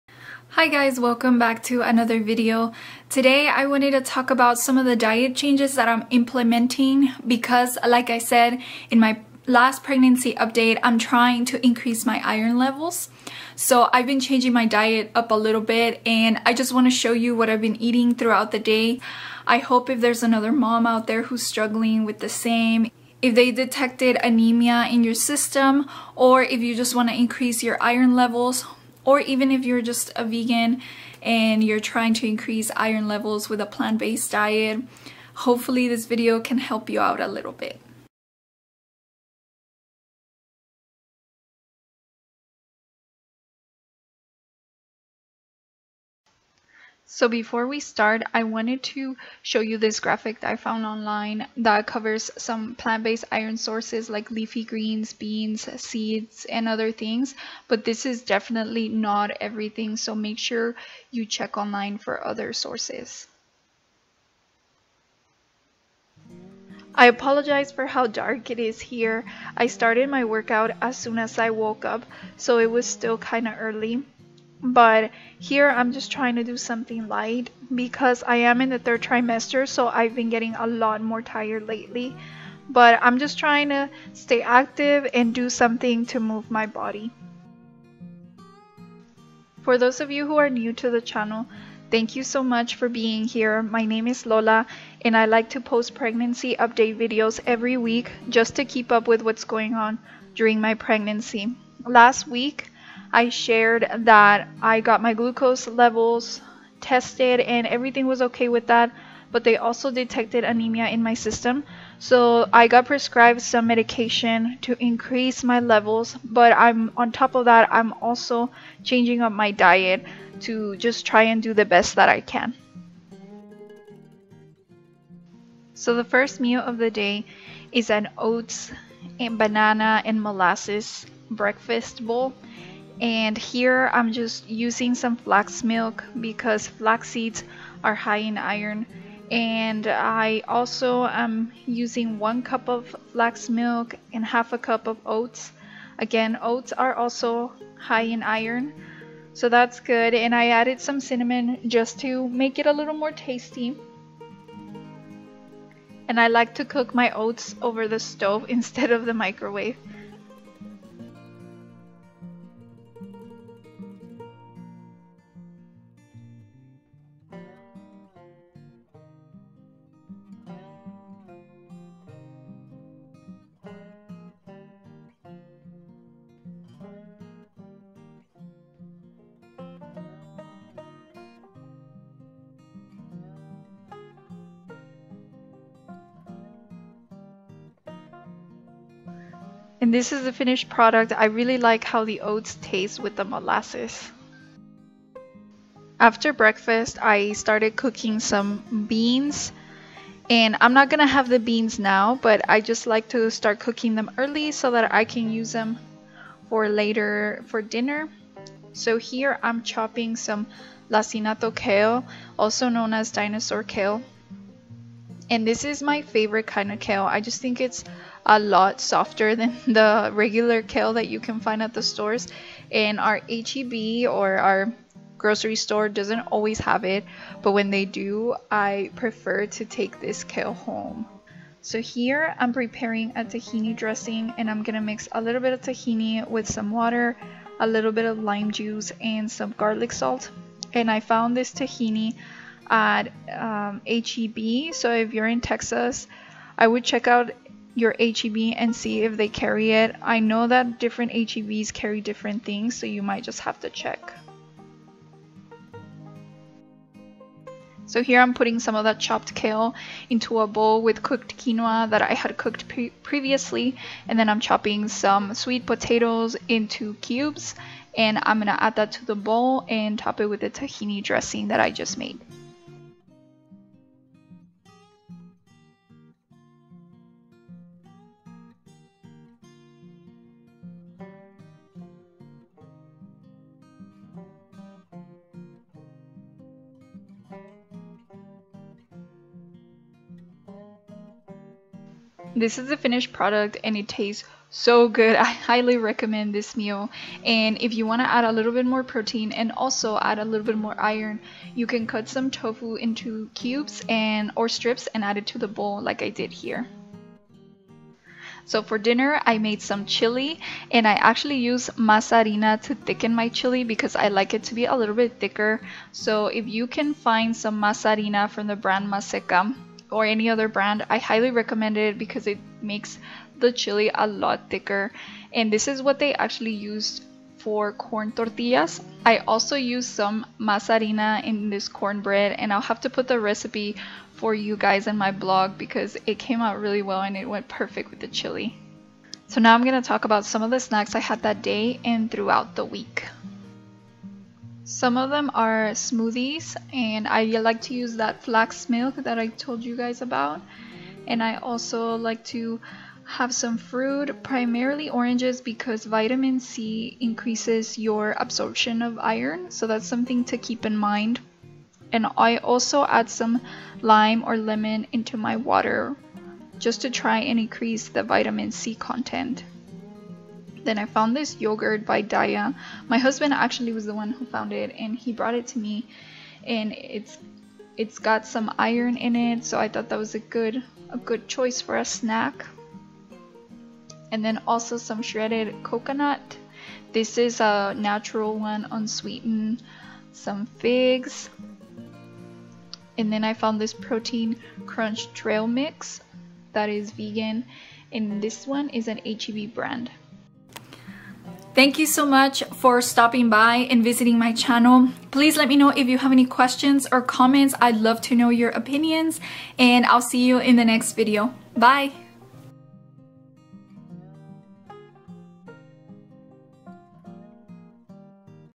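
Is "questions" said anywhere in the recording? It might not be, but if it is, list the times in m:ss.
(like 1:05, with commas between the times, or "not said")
6:46.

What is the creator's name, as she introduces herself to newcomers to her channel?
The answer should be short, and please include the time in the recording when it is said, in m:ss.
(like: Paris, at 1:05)
Lola, at 1:34.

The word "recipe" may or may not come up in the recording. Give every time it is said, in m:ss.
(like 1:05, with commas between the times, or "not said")
5:33.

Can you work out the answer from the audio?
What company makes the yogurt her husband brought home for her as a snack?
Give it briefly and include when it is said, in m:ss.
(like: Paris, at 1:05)
Daiya, at 6:12.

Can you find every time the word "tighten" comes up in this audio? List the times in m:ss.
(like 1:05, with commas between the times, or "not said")
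not said.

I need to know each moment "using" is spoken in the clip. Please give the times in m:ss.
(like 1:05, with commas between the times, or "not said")
2:14, 2:21.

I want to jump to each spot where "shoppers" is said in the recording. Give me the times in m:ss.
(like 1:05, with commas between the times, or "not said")
not said.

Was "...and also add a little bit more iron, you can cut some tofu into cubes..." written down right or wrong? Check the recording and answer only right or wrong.
right.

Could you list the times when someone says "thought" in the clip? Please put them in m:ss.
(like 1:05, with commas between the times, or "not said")
6:19.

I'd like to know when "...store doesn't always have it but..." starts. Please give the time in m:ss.
3:45.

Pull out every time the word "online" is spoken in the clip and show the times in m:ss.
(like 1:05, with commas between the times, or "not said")
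0:50, 1:01.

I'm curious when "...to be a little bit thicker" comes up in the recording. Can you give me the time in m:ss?
5:14.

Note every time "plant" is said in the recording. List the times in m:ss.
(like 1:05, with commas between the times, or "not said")
0:33, 0:52.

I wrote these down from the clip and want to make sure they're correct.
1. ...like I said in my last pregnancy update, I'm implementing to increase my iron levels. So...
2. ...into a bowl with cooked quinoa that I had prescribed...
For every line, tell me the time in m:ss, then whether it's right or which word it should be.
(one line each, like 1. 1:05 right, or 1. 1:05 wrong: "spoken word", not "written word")
1. 0:07 wrong: "trying", not "implementing"
2. 4:20 wrong: "cooked", not "prescribed".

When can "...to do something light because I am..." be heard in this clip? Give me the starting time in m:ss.
1:16.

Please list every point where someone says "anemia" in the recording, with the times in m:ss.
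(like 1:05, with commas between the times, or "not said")
0:24, 1:50.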